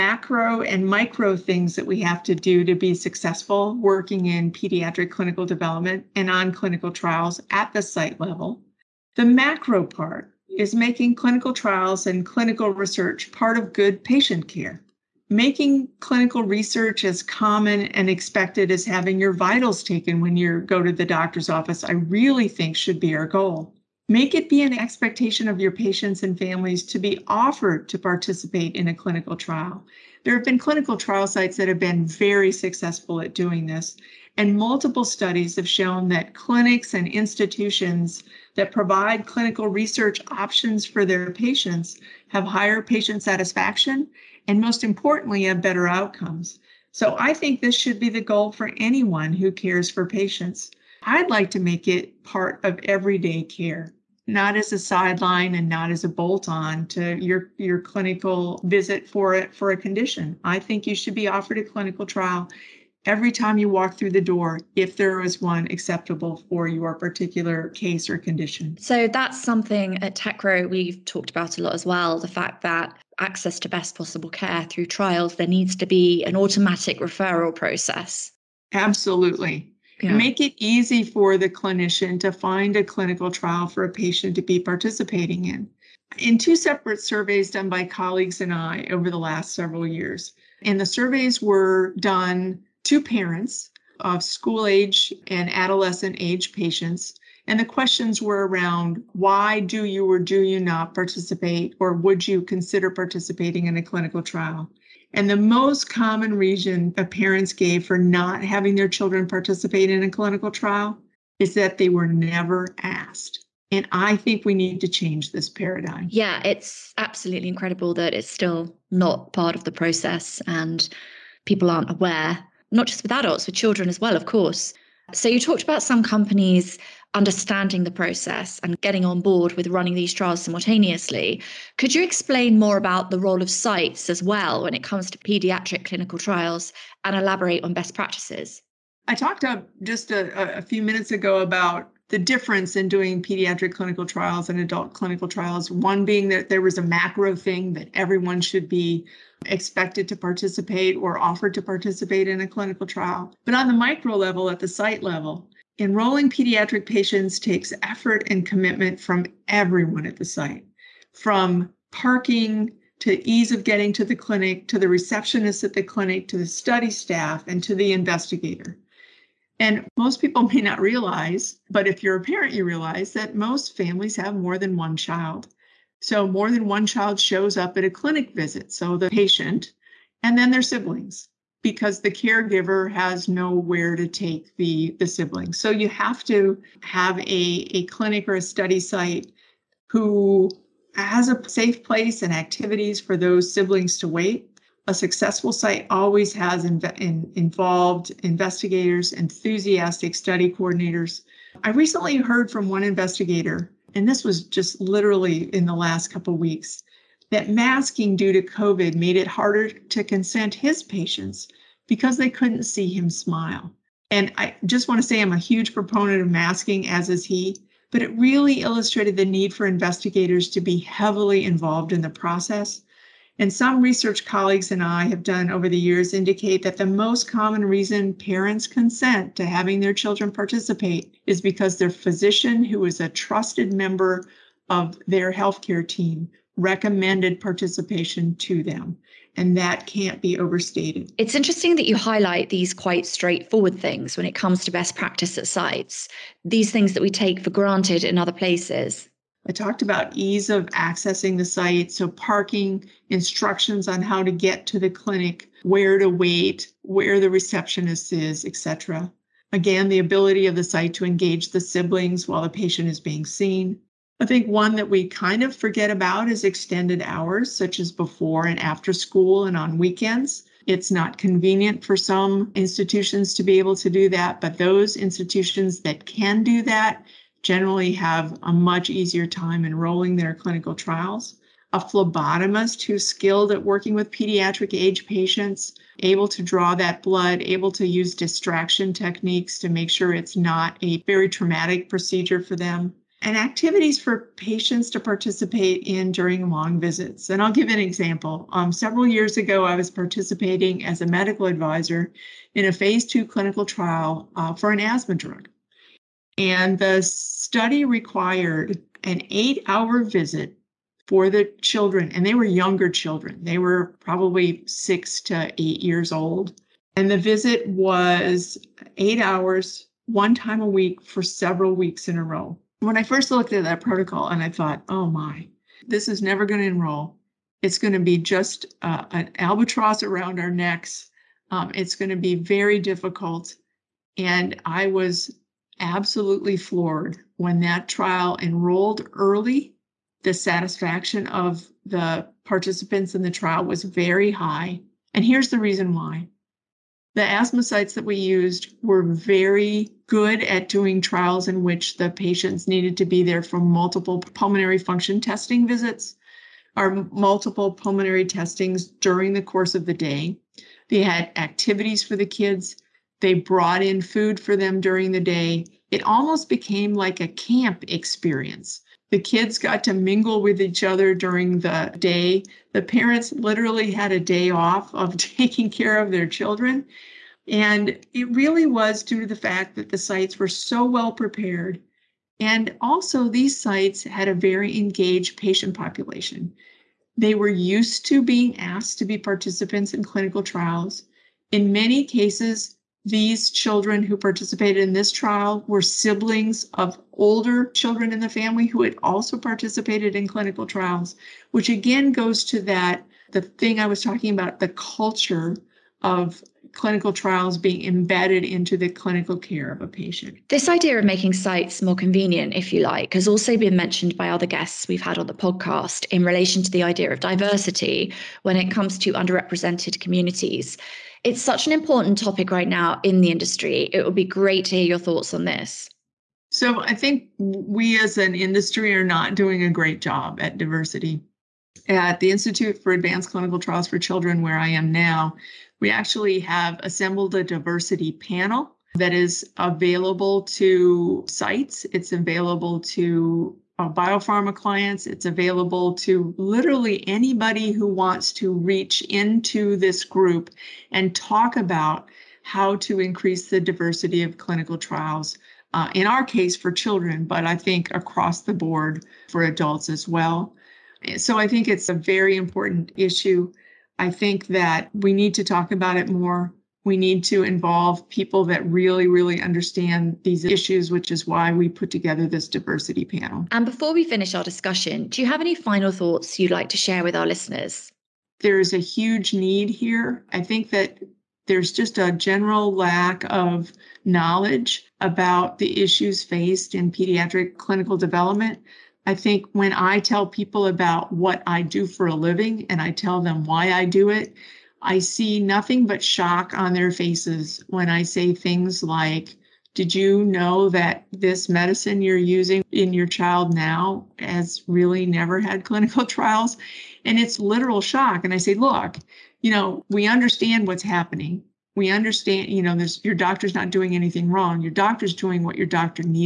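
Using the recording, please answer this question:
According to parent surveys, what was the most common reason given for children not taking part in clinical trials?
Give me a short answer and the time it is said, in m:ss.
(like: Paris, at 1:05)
They were never asked, at 1:51.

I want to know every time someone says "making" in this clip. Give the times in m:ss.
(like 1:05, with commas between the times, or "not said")
0:10, 0:15, 6:51.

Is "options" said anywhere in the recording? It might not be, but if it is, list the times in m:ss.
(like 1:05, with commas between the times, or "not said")
0:40.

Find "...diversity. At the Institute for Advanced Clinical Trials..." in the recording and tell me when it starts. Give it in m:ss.
7:10.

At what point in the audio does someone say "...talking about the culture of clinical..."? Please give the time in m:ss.
6:44.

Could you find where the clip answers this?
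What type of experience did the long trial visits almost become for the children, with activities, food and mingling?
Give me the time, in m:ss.
6:07.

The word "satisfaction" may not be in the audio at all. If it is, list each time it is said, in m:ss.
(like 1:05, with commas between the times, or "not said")
0:43, 5:40.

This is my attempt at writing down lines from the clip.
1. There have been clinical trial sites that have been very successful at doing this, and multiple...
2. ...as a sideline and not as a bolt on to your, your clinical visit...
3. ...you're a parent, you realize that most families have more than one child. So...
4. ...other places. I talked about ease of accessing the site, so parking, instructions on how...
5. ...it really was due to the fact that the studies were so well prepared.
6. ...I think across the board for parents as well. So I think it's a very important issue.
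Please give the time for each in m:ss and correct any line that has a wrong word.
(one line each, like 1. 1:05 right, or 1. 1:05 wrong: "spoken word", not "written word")
1. 0:30 right
2. 0:54 right
3. 2:52 right
4. 4:08 right
5. 6:18 wrong: "sites", not "studies"
6. 7:37 wrong: "adults", not "parents".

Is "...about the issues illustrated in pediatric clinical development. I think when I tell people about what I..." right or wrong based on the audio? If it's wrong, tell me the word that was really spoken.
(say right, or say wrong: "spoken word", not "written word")
wrong: "faced", not "illustrated".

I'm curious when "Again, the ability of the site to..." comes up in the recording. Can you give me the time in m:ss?
4:19.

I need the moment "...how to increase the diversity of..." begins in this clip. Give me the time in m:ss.
7:32.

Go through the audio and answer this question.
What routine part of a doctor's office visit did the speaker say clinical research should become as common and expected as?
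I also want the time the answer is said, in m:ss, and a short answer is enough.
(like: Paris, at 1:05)
Having your vitals taken, at 0:18.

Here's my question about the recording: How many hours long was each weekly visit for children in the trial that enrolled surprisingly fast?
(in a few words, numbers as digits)
8.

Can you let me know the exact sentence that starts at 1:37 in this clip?
And the questions were around why do you or do you not participate, or would you consider participating in a clinical trial?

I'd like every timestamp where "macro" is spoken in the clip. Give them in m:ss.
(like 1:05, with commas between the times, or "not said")
0:09, 2:26.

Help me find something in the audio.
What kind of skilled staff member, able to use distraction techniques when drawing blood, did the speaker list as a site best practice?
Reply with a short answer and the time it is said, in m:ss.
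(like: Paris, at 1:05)
Phlebotomist, at 4:41.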